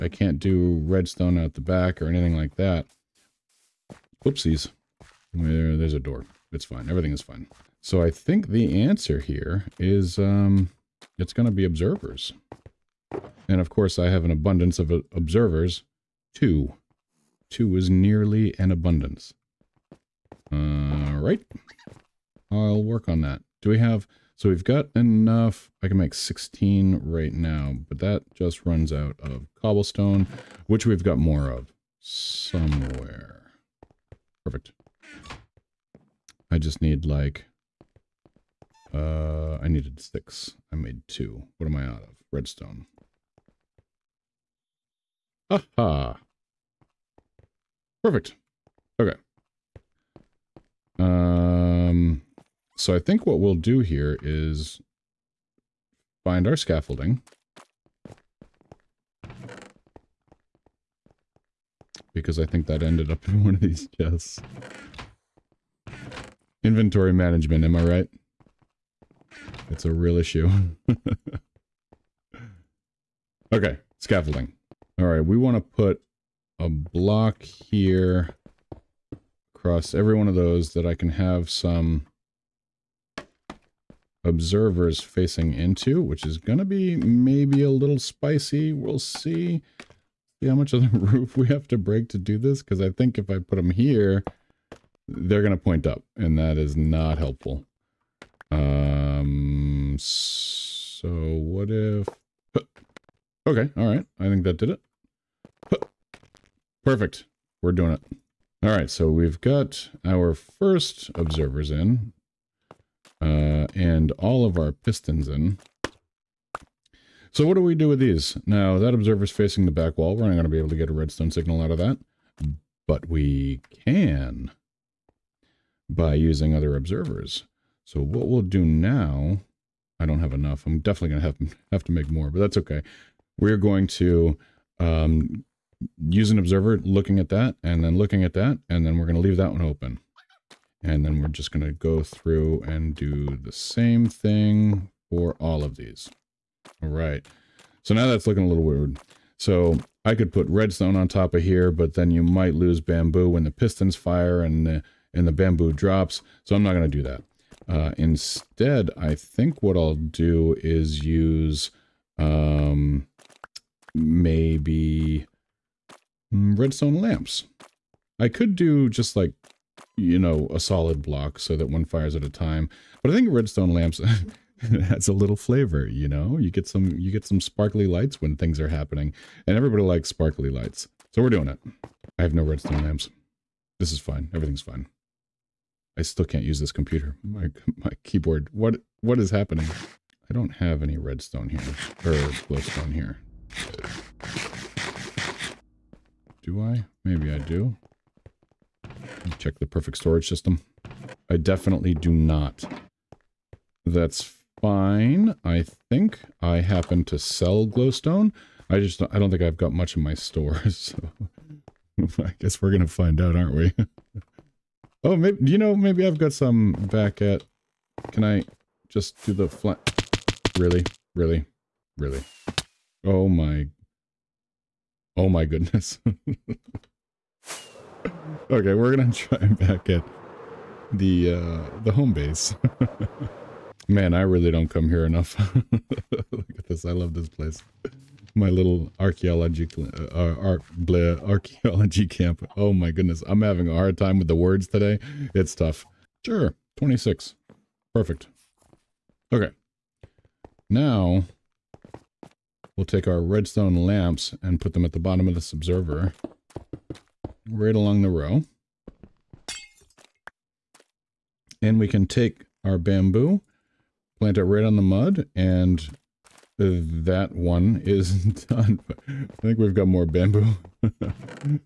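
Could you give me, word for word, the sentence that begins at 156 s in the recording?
So I'm not going to do that.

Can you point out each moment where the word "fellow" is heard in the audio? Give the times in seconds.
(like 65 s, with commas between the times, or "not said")
not said.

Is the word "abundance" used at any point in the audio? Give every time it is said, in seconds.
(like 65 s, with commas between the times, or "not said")
14 s, 18 s.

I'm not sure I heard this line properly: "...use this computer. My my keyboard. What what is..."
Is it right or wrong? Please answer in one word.
right.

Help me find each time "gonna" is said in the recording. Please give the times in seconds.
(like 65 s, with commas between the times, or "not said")
212 s, 228 s.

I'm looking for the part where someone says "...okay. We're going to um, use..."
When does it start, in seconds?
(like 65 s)
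132 s.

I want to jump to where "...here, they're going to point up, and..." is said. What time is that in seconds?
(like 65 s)
93 s.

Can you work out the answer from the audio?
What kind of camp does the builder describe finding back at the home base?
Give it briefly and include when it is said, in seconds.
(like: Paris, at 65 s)
Archaeology camp, at 240 s.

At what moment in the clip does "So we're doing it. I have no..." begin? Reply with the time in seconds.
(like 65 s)
181 s.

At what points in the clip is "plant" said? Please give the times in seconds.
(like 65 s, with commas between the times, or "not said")
264 s.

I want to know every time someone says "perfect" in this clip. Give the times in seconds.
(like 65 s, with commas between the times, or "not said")
34 s, 48 s, 106 s, 199 s, 247 s.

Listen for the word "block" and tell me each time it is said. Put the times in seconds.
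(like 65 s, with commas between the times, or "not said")
76 s, 171 s.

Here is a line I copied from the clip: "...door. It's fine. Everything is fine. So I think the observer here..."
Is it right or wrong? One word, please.
wrong.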